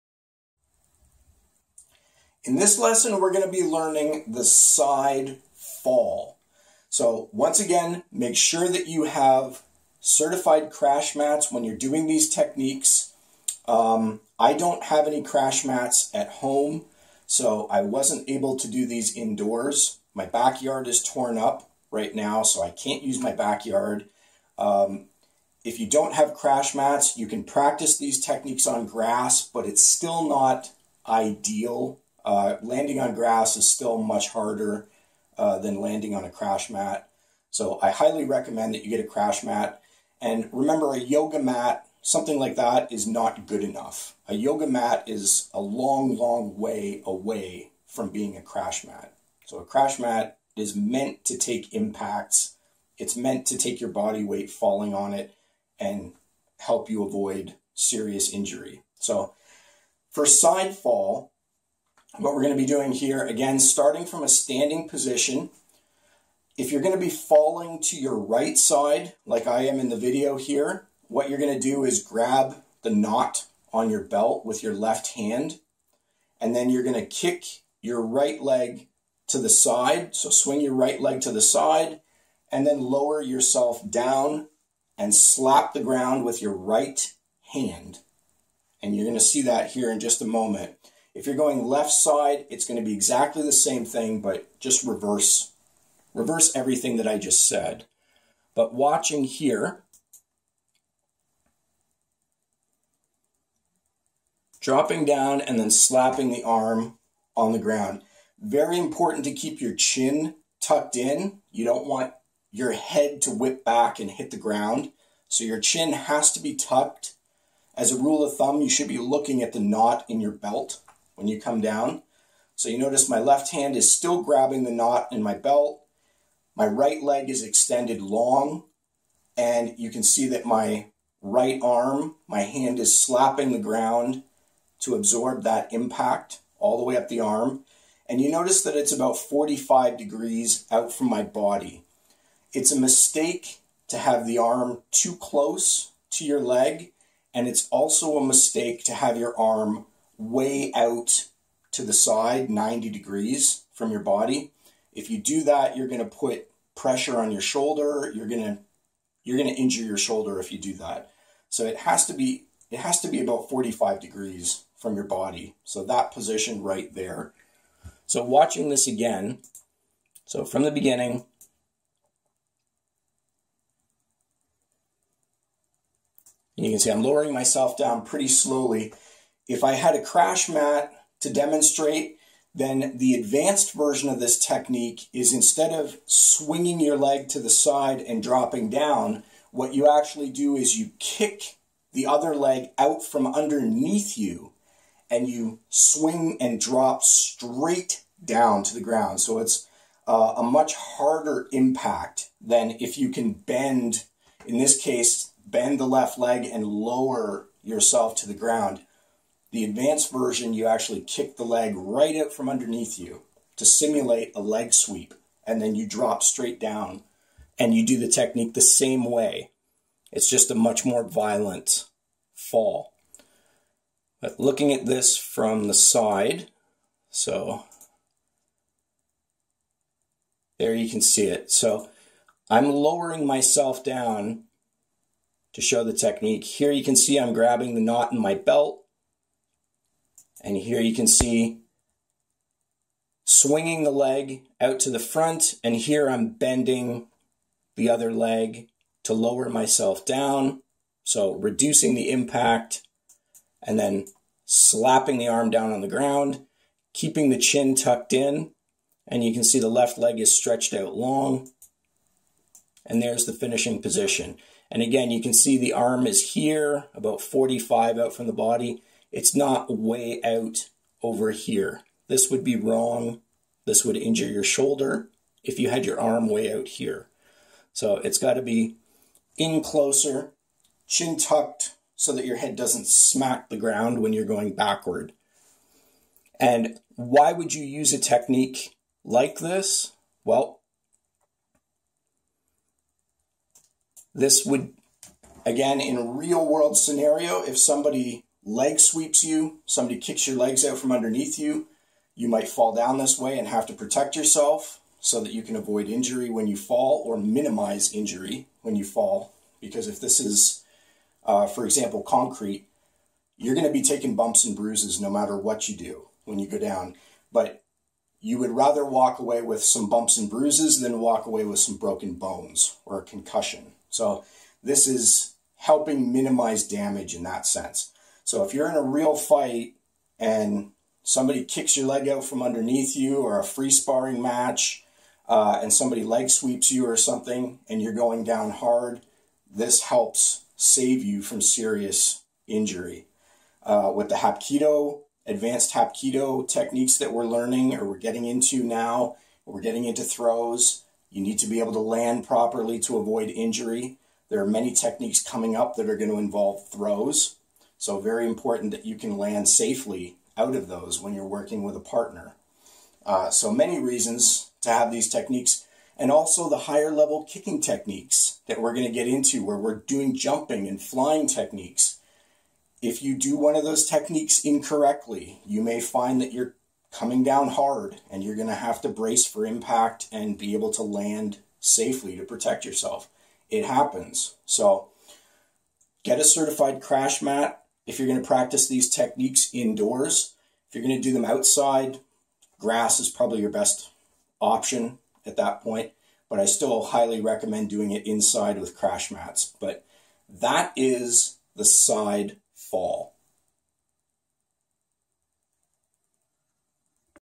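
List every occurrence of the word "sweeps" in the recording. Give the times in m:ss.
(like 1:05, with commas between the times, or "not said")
3:34, 4:58, 5:36.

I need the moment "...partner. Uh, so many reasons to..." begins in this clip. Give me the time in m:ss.
6:01.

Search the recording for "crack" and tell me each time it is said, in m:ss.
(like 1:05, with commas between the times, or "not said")
not said.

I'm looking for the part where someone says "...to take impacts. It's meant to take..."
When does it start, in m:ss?
0:51.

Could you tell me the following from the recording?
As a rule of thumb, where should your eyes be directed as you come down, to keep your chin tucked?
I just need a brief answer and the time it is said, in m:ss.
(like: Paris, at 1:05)
the knot in your belt, at 1:59.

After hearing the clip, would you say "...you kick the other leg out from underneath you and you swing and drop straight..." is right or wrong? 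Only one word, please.
right.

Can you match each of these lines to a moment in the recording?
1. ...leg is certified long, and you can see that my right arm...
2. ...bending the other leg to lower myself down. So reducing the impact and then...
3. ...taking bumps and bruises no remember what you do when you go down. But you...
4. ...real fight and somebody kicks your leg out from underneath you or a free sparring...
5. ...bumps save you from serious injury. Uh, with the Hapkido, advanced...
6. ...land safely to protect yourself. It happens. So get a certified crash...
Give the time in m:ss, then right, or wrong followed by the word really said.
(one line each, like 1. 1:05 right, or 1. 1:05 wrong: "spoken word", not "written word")
1. 2:07 wrong: "extended", not "certified"
2. 4:06 right
3. 5:13 wrong: "matter", not "remember"
4. 5:28 right
5. 5:39 wrong: "helps", not "bumps"
6. 6:20 right.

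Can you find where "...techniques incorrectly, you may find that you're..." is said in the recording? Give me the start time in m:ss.
6:13.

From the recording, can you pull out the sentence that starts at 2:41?
So it has to be it has to be about 45 degrees from your body.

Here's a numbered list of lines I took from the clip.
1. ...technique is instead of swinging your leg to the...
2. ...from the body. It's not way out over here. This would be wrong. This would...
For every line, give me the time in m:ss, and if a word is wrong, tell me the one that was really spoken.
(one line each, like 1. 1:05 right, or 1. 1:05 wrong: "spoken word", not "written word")
1. 3:04 right
2. 4:28 right.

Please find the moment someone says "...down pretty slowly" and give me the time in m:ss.
2:57.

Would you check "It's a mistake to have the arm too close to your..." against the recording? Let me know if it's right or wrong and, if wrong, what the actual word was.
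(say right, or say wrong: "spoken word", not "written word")
right.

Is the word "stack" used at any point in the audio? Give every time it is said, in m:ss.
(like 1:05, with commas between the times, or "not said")
not said.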